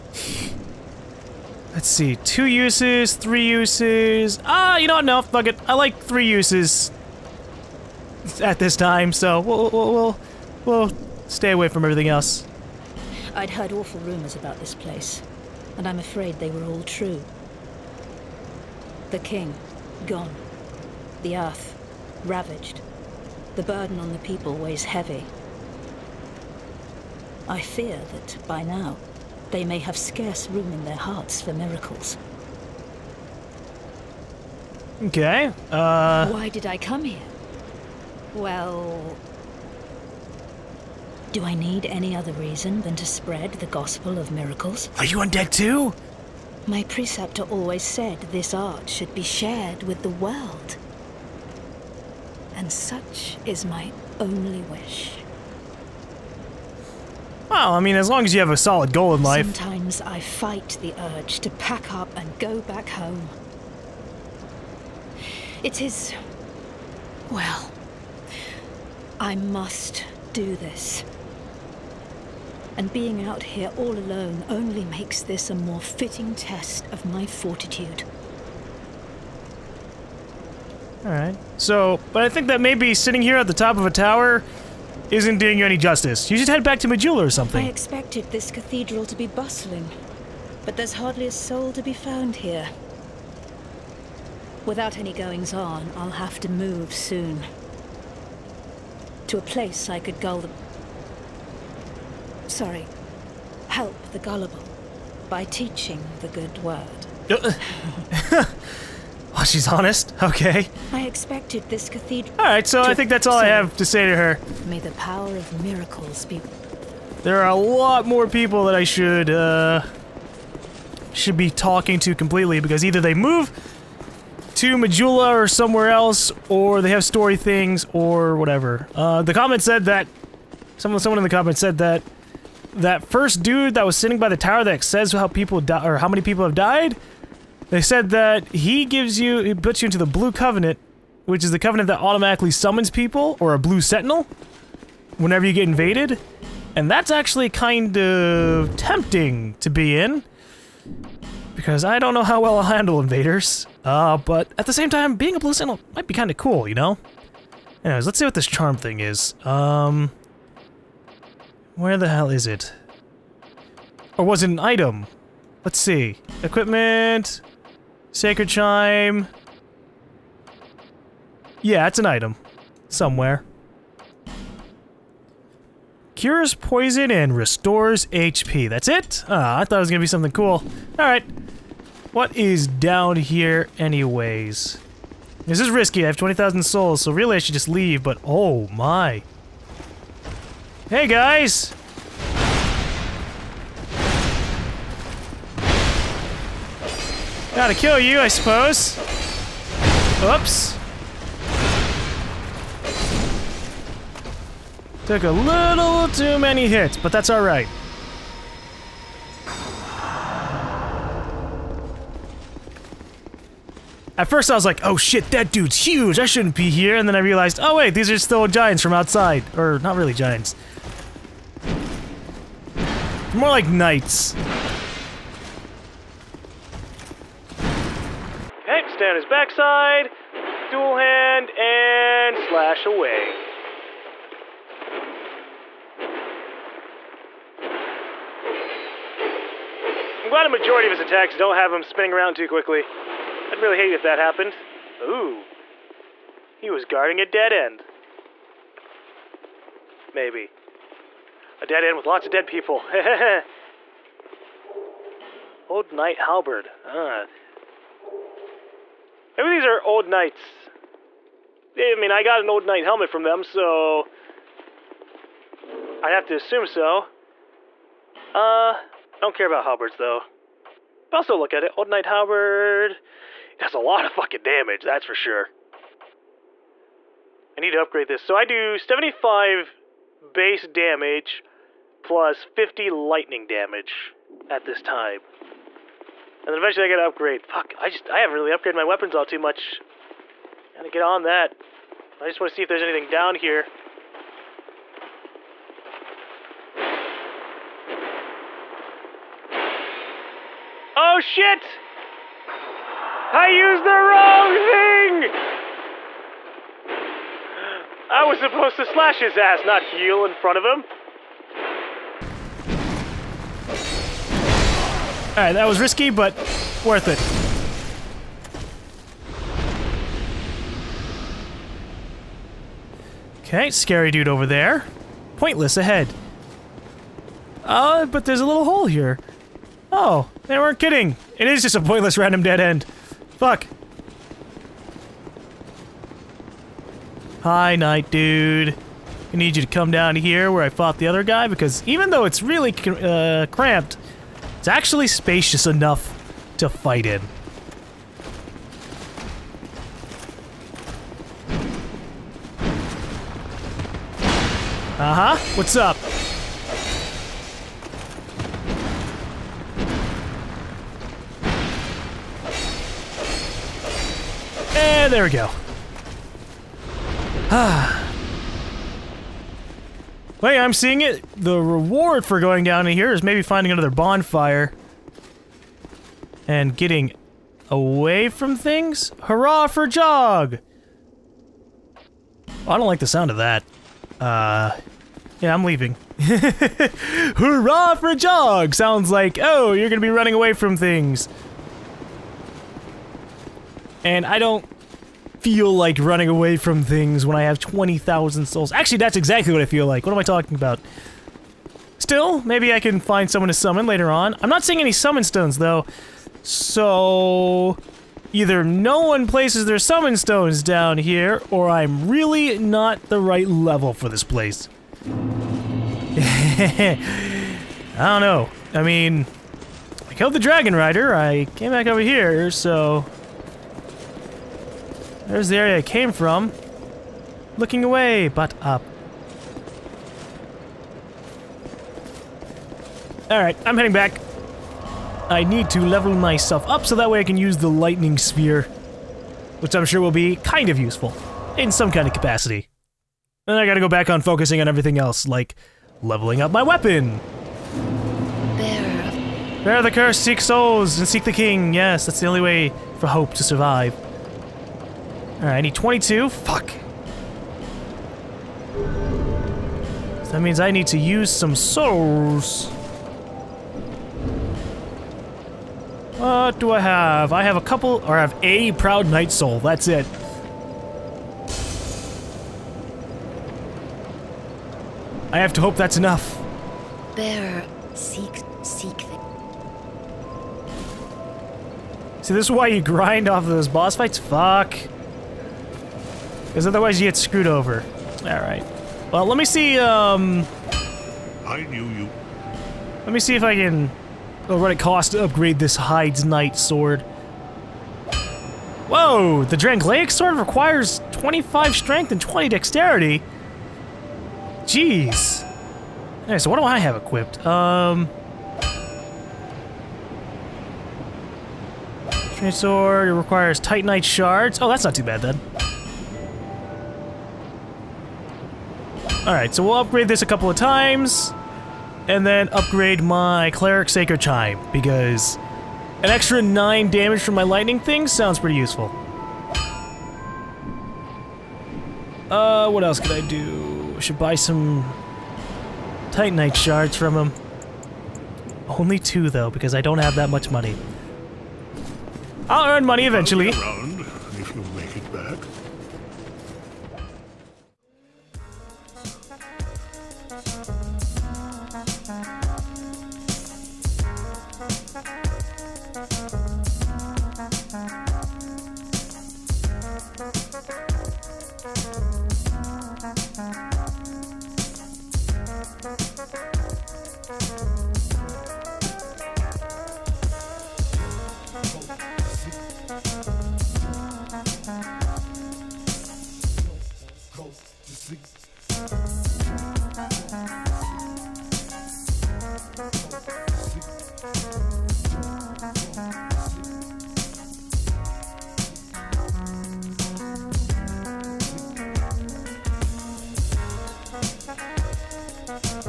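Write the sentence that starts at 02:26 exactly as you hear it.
And that's actually kind of tempting to be in.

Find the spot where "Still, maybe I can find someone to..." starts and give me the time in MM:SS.
06:41.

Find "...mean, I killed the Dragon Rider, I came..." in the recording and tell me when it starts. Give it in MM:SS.
06:58.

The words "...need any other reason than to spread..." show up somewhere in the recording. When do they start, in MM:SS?
00:41.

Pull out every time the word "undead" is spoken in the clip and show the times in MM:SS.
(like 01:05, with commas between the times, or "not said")
00:45.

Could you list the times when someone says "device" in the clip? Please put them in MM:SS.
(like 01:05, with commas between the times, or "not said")
not said.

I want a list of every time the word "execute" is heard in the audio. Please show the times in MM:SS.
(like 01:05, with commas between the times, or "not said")
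not said.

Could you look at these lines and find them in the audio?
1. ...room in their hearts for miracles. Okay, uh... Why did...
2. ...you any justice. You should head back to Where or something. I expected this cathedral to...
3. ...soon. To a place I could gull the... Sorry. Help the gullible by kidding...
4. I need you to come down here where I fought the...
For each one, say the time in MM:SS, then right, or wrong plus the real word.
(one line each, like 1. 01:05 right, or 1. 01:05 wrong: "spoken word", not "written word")
1. 00:30 right
2. 01:25 wrong: "Majula", not "Where"
3. 01:36 wrong: "teaching", not "kidding"
4. 05:39 right.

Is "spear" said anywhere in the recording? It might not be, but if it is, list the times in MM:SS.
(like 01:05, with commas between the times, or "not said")
07:18.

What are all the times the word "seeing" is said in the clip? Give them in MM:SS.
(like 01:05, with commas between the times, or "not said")
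06:10, 06:44.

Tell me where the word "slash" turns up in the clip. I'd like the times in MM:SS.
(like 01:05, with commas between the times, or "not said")
03:52, 05:08.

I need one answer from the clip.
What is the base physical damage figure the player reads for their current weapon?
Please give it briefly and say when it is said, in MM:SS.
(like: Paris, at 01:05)
75, at 04:38.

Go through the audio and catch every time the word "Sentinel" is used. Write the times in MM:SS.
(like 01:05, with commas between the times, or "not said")
02:23, 02:35.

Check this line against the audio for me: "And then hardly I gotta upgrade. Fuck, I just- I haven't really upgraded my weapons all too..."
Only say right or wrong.
wrong.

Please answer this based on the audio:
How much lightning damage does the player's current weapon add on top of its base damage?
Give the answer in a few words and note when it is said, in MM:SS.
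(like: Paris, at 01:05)
50, at 04:42.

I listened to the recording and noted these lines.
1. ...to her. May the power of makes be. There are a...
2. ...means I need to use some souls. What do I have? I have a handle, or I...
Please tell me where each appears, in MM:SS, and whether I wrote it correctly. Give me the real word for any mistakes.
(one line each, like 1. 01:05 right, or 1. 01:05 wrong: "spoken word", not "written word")
1. 01:54 wrong: "miracles", not "makes"
2. 07:40 wrong: "couple", not "handle".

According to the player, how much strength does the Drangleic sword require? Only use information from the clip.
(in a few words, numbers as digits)
25.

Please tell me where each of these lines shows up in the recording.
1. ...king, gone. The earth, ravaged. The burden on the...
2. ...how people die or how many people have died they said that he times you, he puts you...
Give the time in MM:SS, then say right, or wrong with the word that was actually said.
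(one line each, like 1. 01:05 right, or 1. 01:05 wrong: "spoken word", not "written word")
1. 00:19 right
2. 02:15 wrong: "gives", not "times".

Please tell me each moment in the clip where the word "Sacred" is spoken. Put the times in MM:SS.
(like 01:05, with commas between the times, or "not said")
02:48, 08:43.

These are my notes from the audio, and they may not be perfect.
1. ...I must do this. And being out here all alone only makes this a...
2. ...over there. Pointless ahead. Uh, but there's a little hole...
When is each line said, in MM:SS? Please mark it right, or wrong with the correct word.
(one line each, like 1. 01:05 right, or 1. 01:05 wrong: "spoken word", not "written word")
1. 01:09 right
2. 05:24 right.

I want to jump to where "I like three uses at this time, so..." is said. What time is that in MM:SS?
00:05.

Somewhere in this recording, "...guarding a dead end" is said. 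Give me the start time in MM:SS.
04:06.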